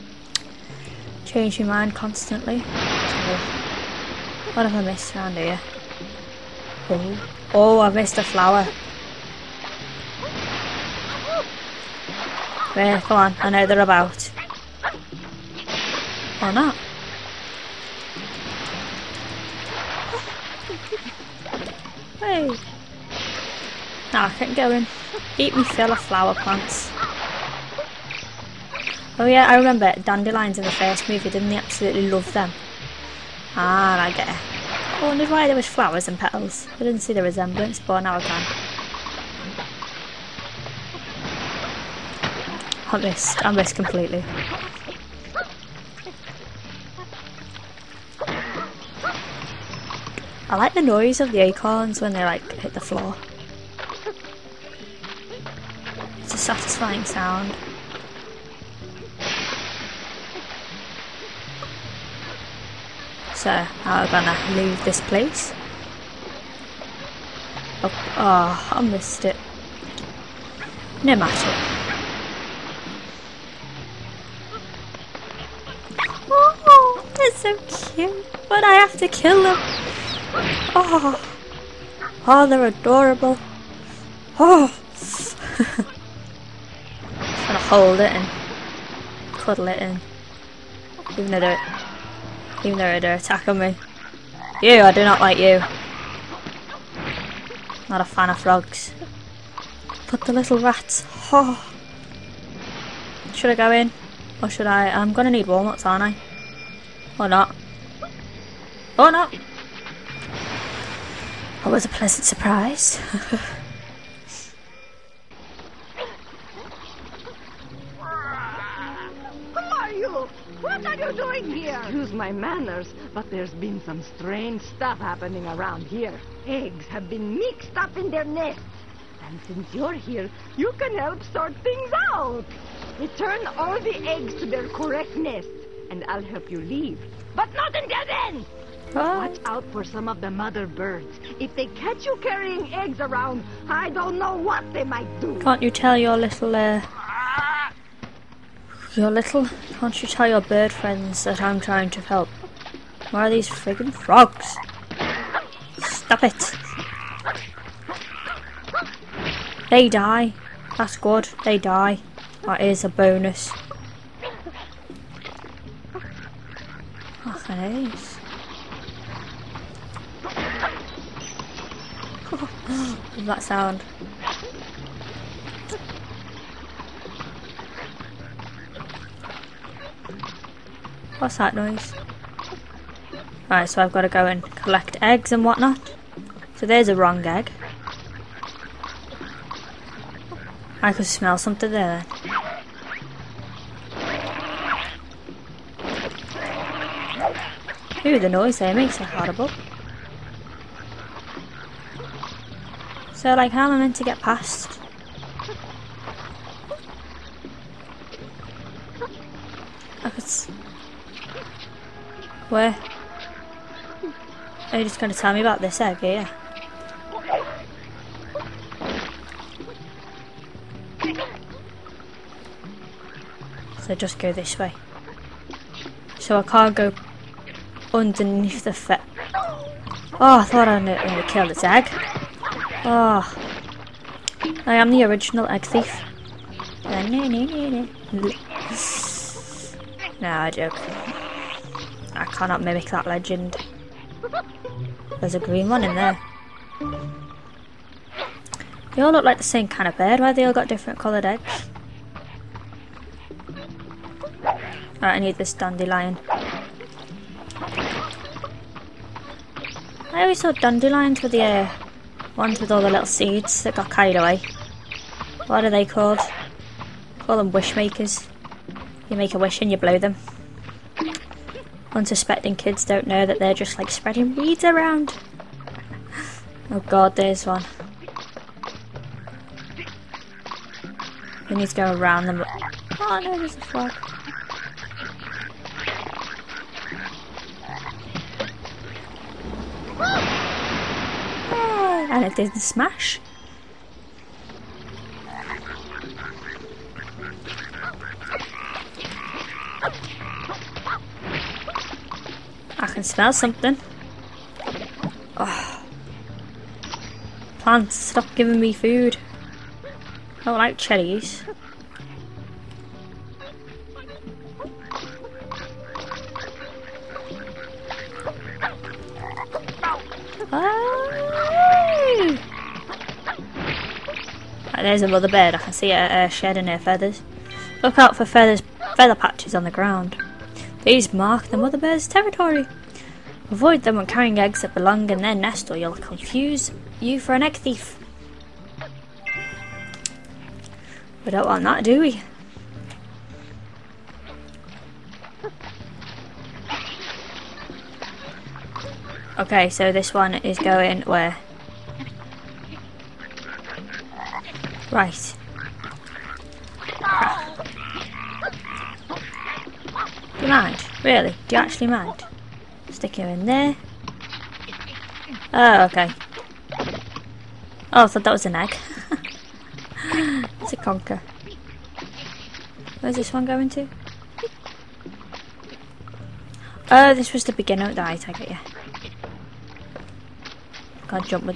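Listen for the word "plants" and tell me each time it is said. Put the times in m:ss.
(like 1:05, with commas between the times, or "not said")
0:26, 5:07.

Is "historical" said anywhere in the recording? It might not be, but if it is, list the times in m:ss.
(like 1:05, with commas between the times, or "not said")
not said.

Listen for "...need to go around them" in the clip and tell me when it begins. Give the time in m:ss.
4:41.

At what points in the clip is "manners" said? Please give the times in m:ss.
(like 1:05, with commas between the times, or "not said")
2:02.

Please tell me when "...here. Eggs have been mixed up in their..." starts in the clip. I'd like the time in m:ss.
2:05.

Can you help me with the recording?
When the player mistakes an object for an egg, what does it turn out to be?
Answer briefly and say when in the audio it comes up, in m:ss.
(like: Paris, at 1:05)
A conker, at 6:10.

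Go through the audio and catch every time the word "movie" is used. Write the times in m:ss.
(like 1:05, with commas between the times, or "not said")
0:31.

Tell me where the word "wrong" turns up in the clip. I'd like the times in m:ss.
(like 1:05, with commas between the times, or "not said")
3:06.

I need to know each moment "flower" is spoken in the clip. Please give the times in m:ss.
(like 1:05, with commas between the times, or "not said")
0:08, 0:25, 0:35.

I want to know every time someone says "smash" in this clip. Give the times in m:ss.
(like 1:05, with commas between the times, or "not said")
4:52.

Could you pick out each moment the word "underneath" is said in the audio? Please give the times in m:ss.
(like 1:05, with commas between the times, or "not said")
3:47.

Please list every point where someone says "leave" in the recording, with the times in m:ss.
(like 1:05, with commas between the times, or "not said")
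1:04, 2:16.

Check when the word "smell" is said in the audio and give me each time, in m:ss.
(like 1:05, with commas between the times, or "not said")
3:11, 5:03.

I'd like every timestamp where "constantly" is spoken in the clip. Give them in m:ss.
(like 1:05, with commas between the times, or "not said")
0:01.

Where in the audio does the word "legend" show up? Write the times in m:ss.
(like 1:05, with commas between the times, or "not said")
4:03.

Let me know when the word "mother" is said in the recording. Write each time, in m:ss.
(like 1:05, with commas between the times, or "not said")
2:20, 5:31.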